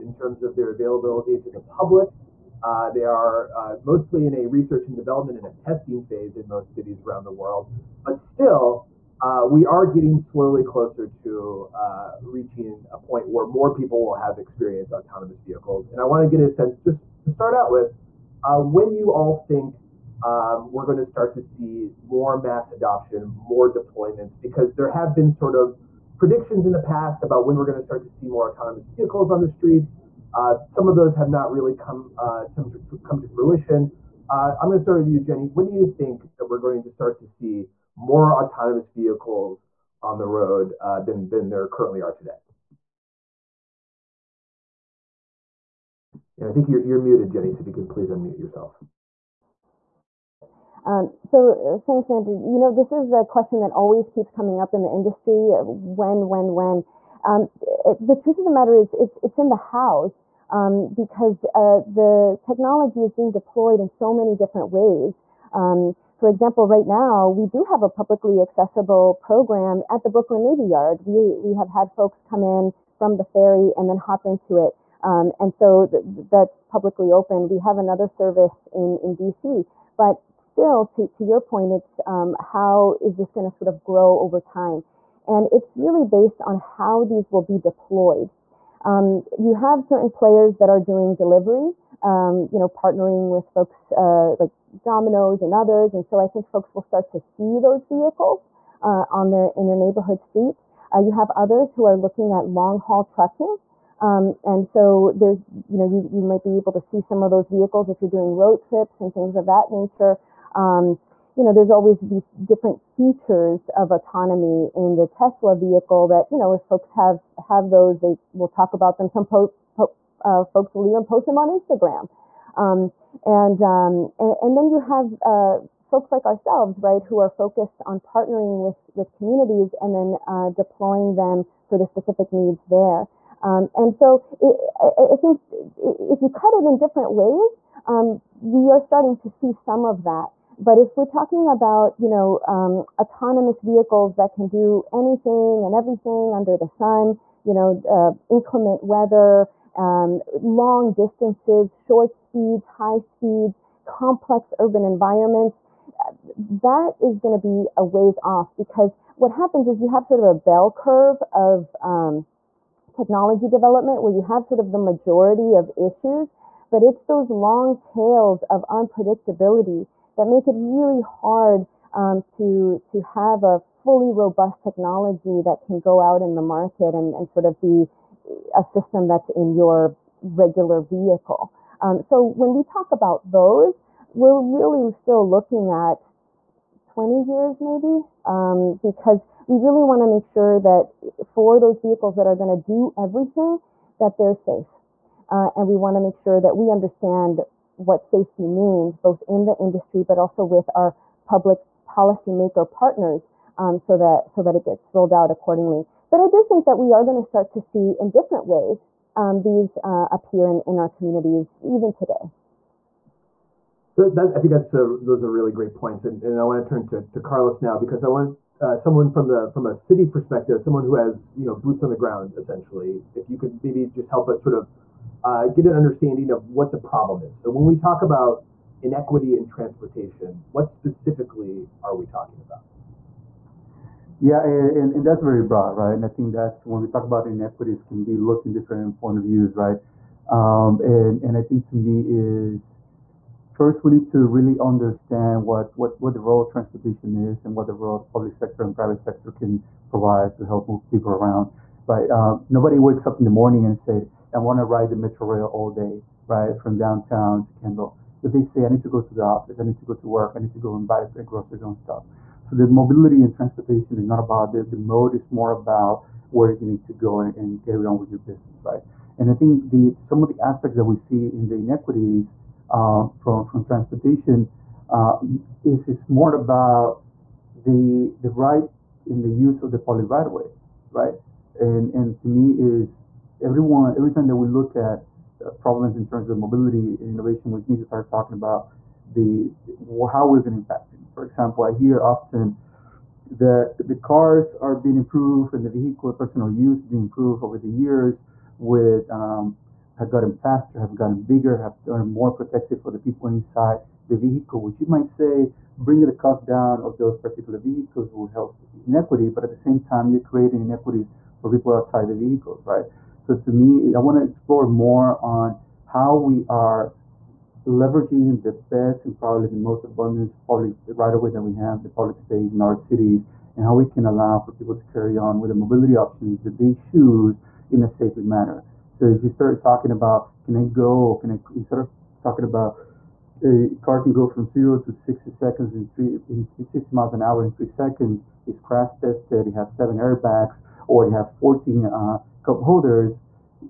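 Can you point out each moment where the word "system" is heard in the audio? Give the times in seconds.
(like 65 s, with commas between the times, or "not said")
178 s.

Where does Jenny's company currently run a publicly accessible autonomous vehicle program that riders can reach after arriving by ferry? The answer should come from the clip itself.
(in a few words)
Brooklyn Navy Yard.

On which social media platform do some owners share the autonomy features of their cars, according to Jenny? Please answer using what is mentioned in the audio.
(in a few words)
Instagram.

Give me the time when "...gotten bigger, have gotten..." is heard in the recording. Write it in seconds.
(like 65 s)
300 s.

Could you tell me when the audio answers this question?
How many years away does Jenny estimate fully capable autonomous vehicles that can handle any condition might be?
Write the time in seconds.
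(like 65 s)
186 s.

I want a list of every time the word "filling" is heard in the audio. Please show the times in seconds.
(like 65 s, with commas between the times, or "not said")
not said.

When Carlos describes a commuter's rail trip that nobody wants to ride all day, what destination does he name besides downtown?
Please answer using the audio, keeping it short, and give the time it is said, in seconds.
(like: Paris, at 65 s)
Kendall, at 257 s.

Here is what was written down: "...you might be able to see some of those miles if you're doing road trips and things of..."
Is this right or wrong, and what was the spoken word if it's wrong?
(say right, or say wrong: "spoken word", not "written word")
wrong: "vehicles", not "miles".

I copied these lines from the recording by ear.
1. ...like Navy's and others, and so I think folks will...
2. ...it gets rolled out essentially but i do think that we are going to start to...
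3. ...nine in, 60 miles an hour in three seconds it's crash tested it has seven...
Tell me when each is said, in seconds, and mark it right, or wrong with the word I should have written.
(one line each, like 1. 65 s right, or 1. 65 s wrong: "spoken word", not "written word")
1. 94 s wrong: "Domino", not "Navy"
2. 204 s wrong: "accordingly", not "essentially"
3. 335 s wrong: "three", not "nine".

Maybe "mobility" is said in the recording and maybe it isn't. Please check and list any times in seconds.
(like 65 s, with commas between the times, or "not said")
262 s, 286 s, 325 s.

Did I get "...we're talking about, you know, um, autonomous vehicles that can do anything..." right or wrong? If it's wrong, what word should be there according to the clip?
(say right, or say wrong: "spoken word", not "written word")
right.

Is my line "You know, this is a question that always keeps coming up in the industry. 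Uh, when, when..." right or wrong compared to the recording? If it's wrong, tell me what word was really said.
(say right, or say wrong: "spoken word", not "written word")
right.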